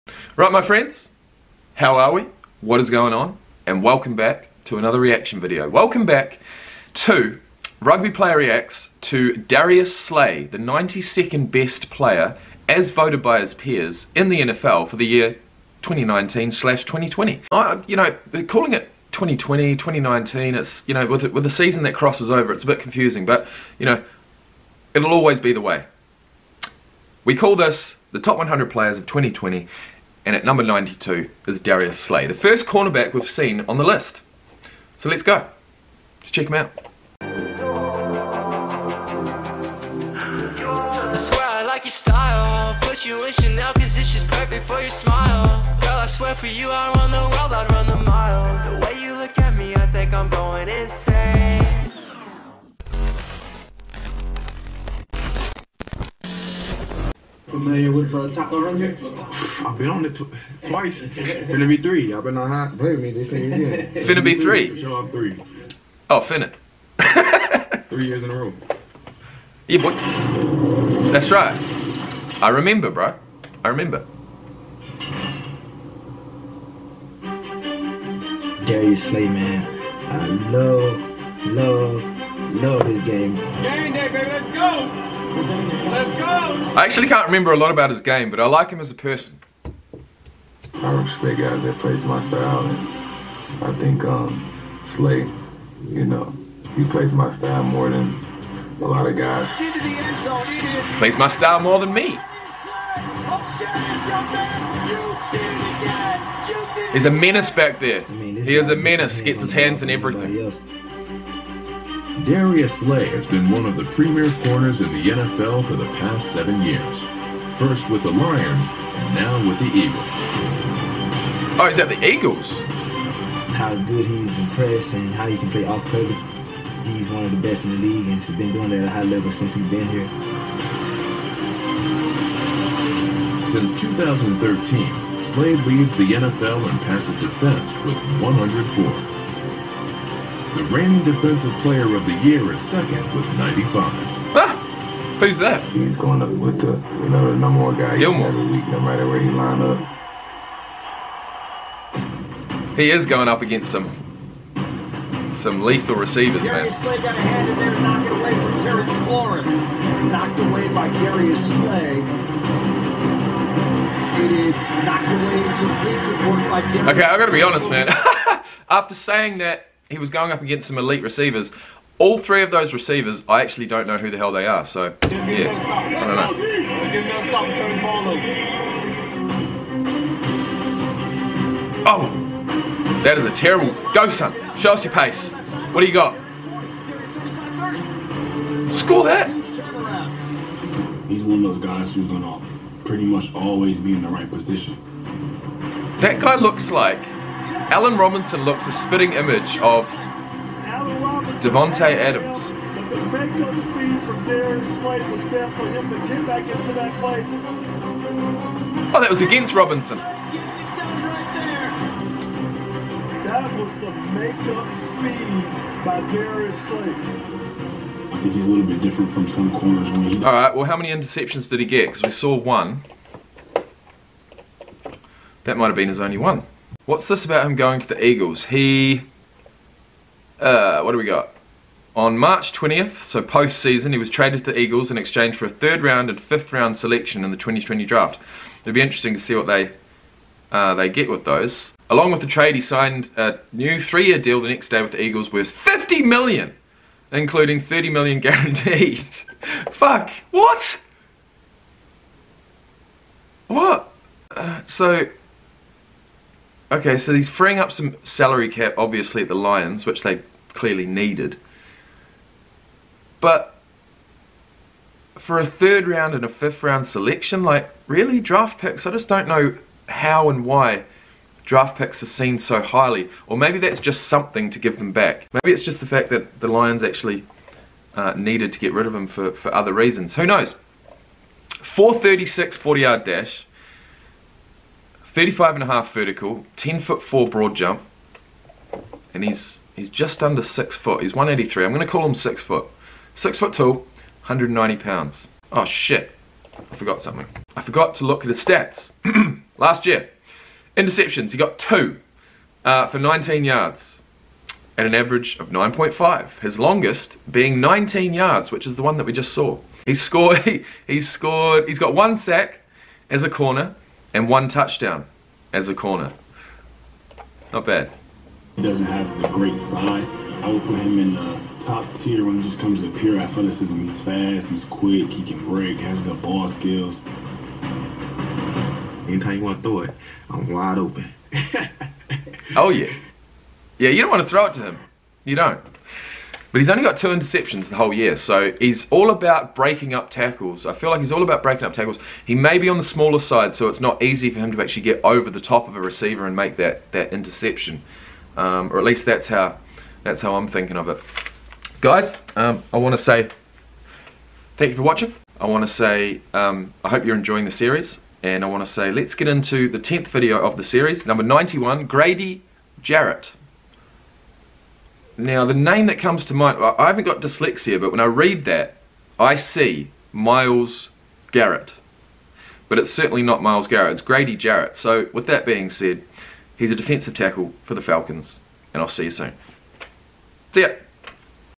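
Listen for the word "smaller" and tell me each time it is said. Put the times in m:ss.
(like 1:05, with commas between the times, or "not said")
5:42.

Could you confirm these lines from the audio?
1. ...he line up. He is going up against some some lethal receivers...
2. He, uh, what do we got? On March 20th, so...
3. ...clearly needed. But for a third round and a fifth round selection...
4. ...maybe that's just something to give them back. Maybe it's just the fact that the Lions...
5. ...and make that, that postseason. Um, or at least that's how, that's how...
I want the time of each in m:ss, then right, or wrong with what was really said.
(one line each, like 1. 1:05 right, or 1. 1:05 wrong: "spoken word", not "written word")
1. 2:29 right
2. 3:48 right
3. 4:20 right
4. 4:33 right
5. 5:46 wrong: "interception", not "postseason".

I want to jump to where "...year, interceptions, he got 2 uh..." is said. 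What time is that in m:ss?
4:59.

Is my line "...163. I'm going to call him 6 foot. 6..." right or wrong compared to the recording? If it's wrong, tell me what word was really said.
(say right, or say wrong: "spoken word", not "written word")
wrong: "183", not "163".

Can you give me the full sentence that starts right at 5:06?
His longest being 19 yards, which is the one that we just saw.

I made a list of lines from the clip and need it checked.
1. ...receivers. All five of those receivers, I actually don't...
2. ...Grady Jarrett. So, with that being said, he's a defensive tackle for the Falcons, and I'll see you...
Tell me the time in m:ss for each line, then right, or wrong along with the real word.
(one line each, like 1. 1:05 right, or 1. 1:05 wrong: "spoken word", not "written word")
1. 2:51 wrong: "three", not "five"
2. 6:14 right.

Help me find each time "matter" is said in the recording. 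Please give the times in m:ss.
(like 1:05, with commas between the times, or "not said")
2:28.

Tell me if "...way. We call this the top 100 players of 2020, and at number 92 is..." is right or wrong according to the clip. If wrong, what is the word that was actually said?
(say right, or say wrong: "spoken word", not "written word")
right.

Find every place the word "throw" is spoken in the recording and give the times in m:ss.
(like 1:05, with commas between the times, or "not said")
5:29, 5:34.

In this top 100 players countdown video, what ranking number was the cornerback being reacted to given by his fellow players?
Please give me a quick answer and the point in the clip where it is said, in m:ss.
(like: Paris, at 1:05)
92, at 0:10.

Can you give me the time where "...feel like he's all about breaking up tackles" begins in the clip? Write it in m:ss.
5:40.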